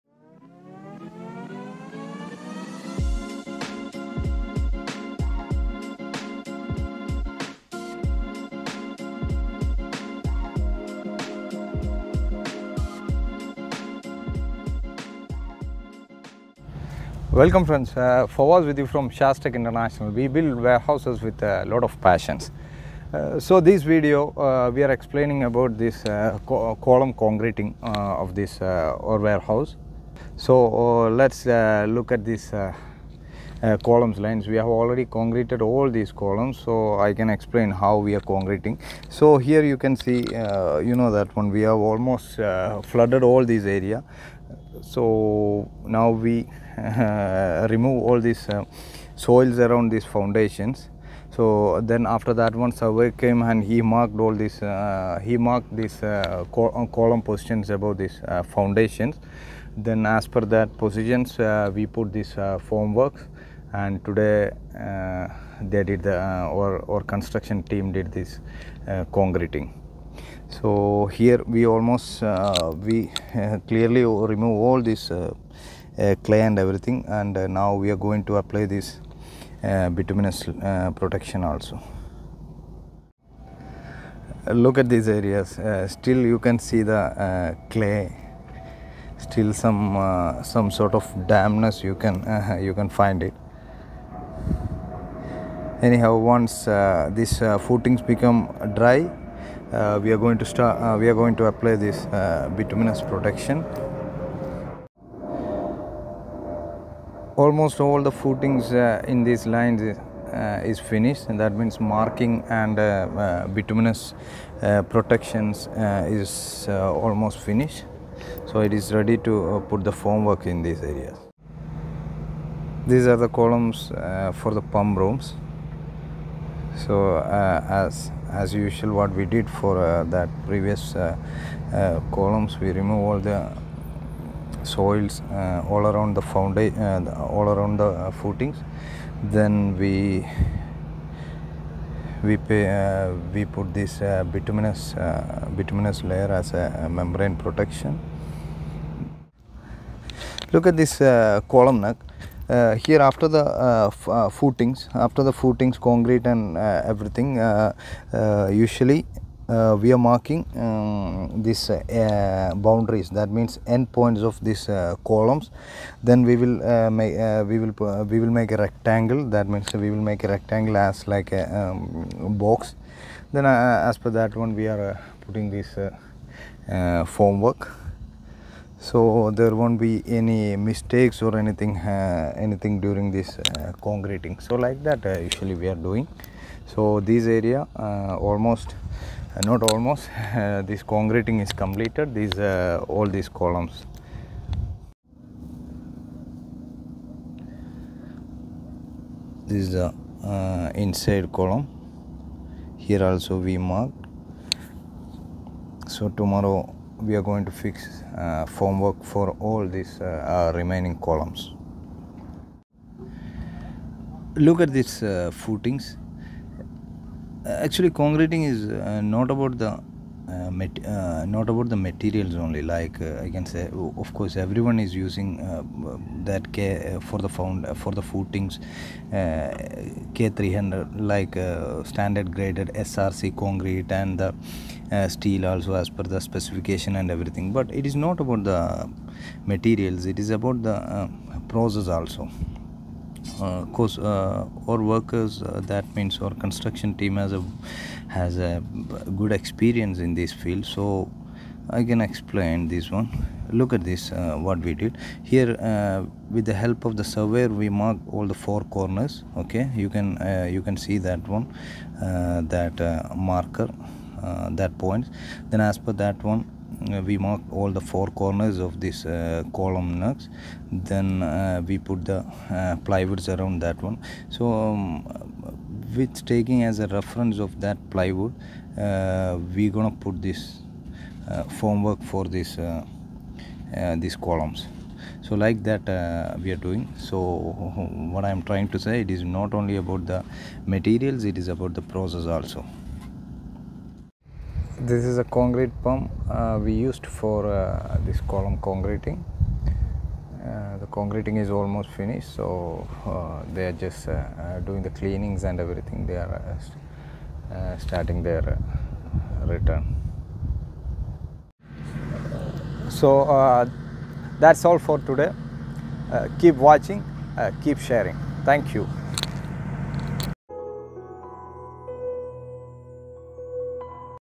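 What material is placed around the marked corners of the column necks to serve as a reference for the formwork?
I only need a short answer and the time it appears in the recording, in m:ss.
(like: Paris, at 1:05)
Plywood, at 4:32.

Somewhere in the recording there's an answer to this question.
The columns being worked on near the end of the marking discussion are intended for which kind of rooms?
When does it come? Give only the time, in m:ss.
2:04.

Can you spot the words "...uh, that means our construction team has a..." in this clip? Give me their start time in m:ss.
4:05.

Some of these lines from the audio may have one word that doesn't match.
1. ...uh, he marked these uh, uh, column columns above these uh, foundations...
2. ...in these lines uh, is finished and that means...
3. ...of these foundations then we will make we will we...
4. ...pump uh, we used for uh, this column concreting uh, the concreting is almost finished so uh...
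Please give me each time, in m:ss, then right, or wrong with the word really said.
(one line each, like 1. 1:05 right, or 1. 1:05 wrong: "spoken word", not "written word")
1. 0:54 wrong: "positions", not "columns"
2. 1:48 right
3. 2:44 wrong: "columns", not "foundations"
4. 4:55 right.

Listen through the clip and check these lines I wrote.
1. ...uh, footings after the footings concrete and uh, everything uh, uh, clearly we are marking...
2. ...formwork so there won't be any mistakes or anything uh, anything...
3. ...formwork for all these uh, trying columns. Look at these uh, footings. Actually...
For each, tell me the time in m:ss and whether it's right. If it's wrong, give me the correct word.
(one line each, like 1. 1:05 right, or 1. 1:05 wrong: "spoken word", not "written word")
1. 2:34 wrong: "usually", not "clearly"
2. 2:57 right
3. 3:28 wrong: "remaining", not "trying".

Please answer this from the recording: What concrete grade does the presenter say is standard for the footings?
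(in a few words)
K300.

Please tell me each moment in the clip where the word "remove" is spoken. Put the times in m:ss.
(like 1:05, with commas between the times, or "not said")
0:47, 1:14, 2:12.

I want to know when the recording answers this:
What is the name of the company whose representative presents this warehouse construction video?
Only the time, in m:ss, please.
0:19.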